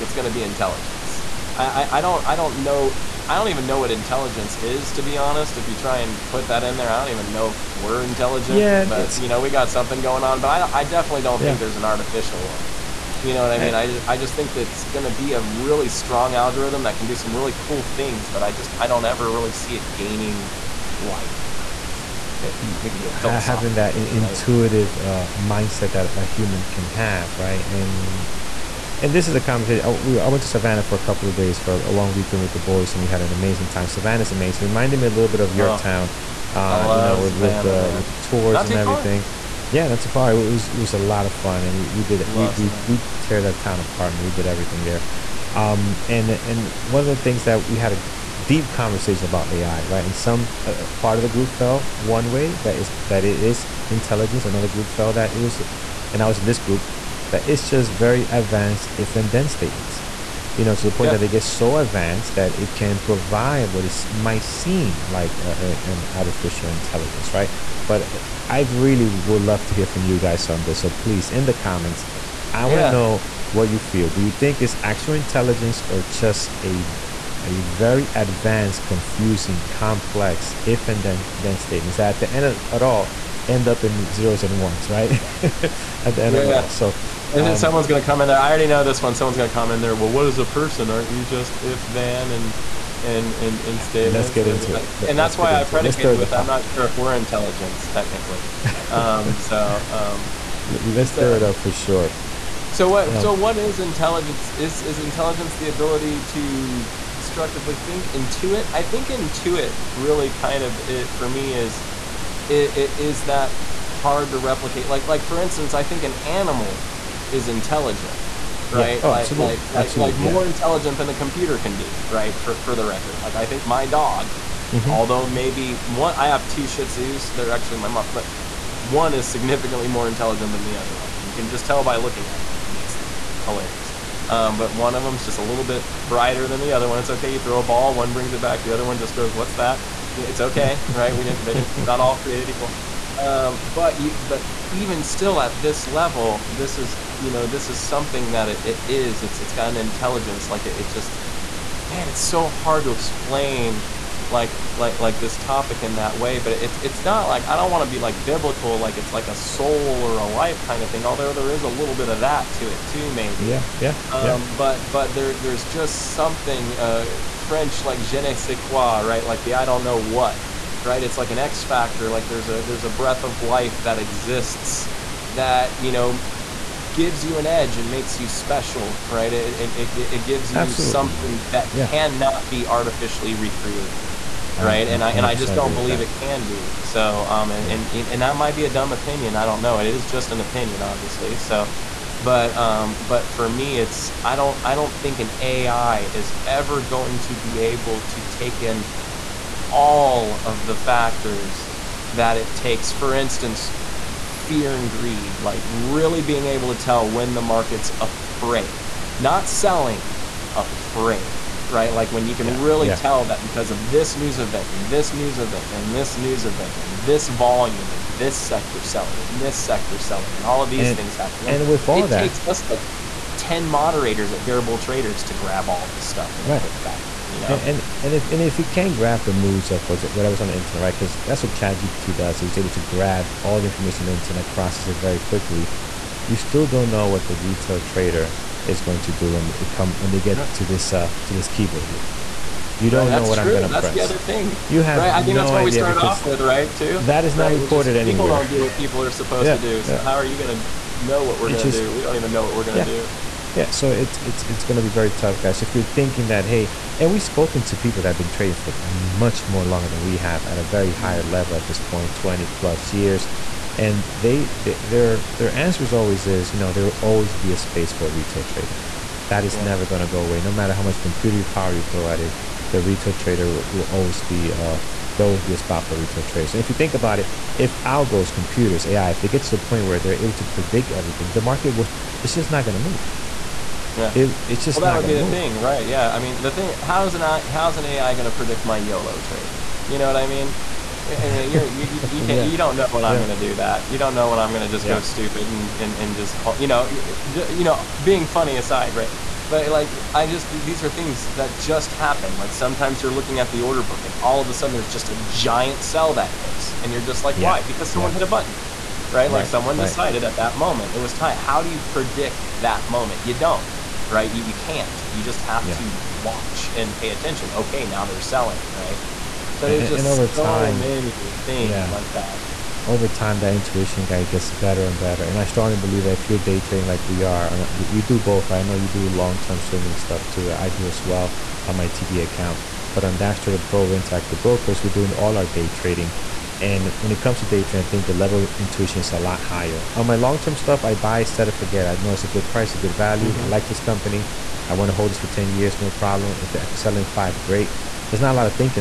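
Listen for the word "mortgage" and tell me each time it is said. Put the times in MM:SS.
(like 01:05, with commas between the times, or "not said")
not said.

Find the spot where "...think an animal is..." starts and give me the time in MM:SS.
01:55.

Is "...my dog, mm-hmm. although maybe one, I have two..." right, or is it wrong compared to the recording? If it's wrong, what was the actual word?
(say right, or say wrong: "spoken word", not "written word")
right.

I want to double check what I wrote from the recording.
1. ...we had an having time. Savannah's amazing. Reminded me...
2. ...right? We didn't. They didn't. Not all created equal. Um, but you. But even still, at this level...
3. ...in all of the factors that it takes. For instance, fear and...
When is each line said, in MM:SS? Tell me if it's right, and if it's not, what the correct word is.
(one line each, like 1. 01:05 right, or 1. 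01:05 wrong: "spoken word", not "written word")
1. 00:33 wrong: "amazing", not "having"
2. 02:20 right
3. 03:18 right.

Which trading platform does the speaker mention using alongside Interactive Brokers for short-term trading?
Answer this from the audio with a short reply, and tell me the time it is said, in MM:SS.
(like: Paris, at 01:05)
DAS Trader Pro, at 05:33.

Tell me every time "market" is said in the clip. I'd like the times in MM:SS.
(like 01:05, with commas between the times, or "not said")
03:27, 04:41.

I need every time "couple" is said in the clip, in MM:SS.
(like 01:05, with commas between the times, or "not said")
00:30.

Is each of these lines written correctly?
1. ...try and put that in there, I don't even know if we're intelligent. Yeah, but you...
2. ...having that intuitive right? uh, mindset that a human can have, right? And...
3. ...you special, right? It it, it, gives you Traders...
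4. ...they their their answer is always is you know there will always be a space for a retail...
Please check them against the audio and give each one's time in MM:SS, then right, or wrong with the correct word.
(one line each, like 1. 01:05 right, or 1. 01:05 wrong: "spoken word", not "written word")
1. 00:05 right
2. 00:23 right
3. 02:58 wrong: "Absolutely", not "Traders"
4. 04:24 right.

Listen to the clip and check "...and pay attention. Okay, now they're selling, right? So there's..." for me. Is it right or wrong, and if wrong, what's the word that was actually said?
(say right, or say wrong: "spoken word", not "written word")
right.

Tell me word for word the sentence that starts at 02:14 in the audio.
Um, but one of them's just a little bit brighter than the other one.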